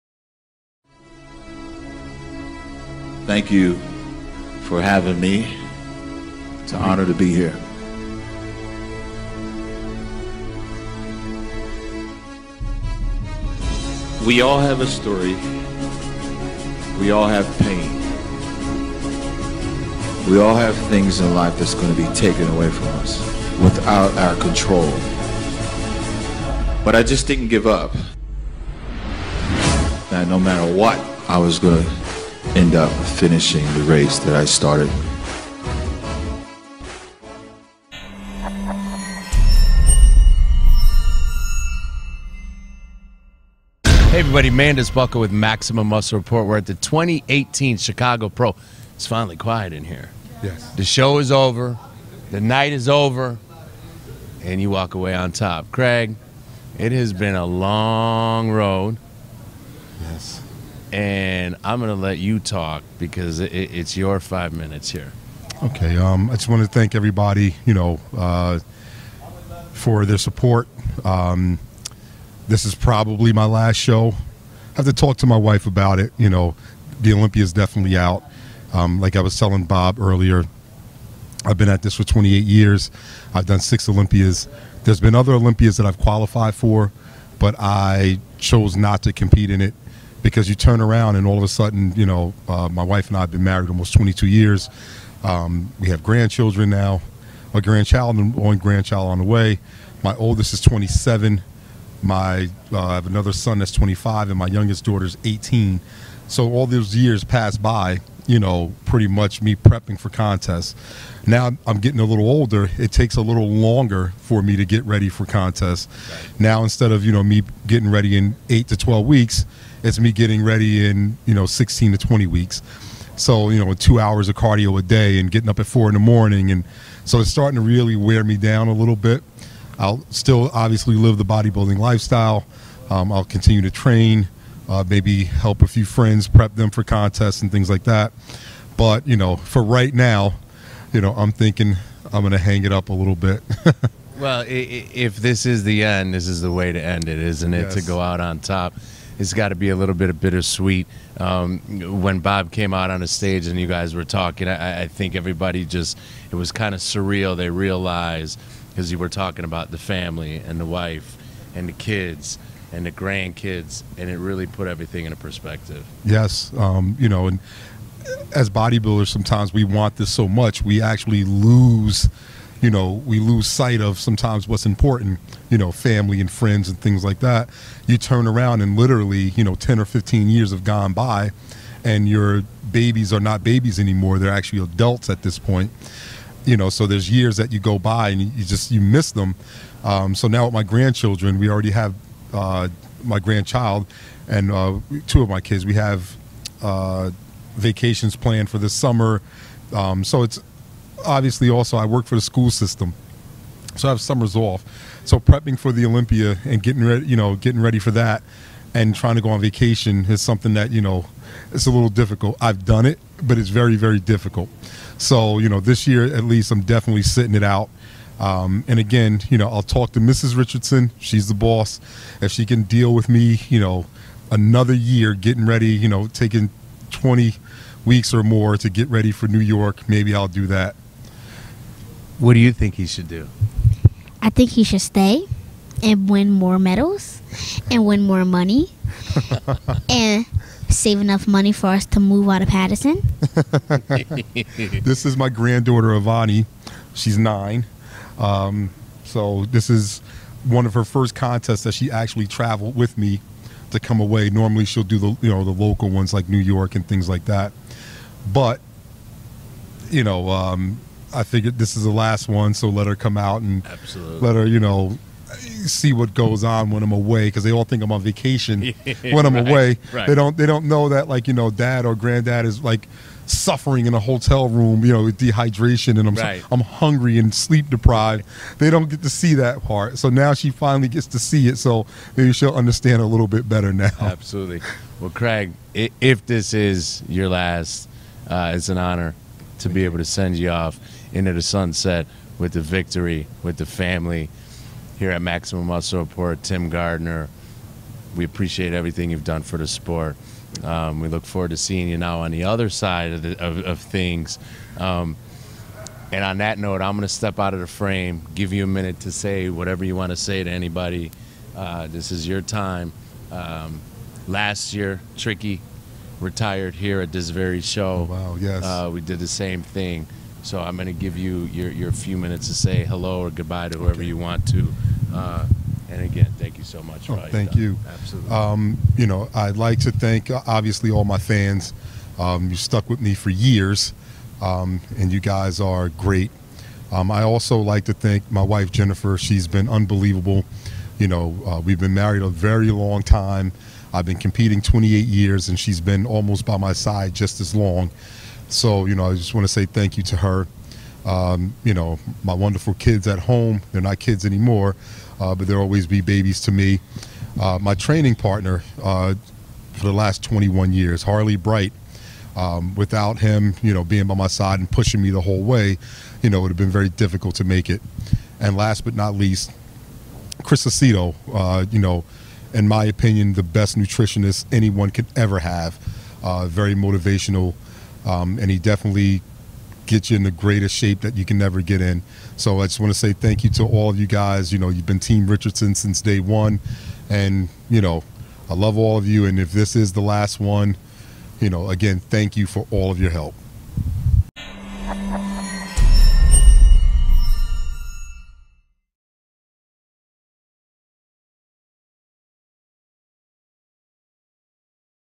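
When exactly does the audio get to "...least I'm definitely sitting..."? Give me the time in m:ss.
3:36.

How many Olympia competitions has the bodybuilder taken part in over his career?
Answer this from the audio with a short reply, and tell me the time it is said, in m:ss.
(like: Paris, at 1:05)
6, at 1:23.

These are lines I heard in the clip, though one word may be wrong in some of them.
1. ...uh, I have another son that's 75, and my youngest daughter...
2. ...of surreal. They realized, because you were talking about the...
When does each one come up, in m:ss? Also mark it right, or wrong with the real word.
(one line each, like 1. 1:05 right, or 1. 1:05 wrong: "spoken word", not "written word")
1. 1:42 wrong: "25", not "75"
2. 2:36 right.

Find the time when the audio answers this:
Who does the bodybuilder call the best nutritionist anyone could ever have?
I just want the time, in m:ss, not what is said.
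6:10.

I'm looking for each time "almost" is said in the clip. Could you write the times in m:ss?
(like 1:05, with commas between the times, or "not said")
1:33, 5:46.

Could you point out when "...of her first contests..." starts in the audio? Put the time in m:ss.
4:10.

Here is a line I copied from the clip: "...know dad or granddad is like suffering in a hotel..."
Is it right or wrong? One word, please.
right.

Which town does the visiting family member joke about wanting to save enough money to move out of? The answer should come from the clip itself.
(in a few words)
Paterson.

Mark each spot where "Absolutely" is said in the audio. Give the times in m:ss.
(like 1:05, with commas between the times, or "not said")
4:23, 4:44, 5:27.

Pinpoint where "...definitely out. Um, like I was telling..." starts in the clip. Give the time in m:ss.
1:17.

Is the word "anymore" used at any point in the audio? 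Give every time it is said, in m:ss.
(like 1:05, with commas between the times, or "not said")
3:03, 5:54.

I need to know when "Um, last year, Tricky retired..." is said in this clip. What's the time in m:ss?
5:13.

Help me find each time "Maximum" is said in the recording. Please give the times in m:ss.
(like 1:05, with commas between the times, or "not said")
0:45, 4:55.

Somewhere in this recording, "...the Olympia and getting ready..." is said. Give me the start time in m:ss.
3:25.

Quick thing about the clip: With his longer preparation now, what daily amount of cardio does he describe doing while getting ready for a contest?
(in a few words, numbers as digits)
2 hours.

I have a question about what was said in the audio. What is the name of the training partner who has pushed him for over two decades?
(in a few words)
Harley Bright.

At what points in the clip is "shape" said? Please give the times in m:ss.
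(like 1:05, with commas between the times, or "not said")
6:20.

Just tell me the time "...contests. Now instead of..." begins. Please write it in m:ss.
1:55.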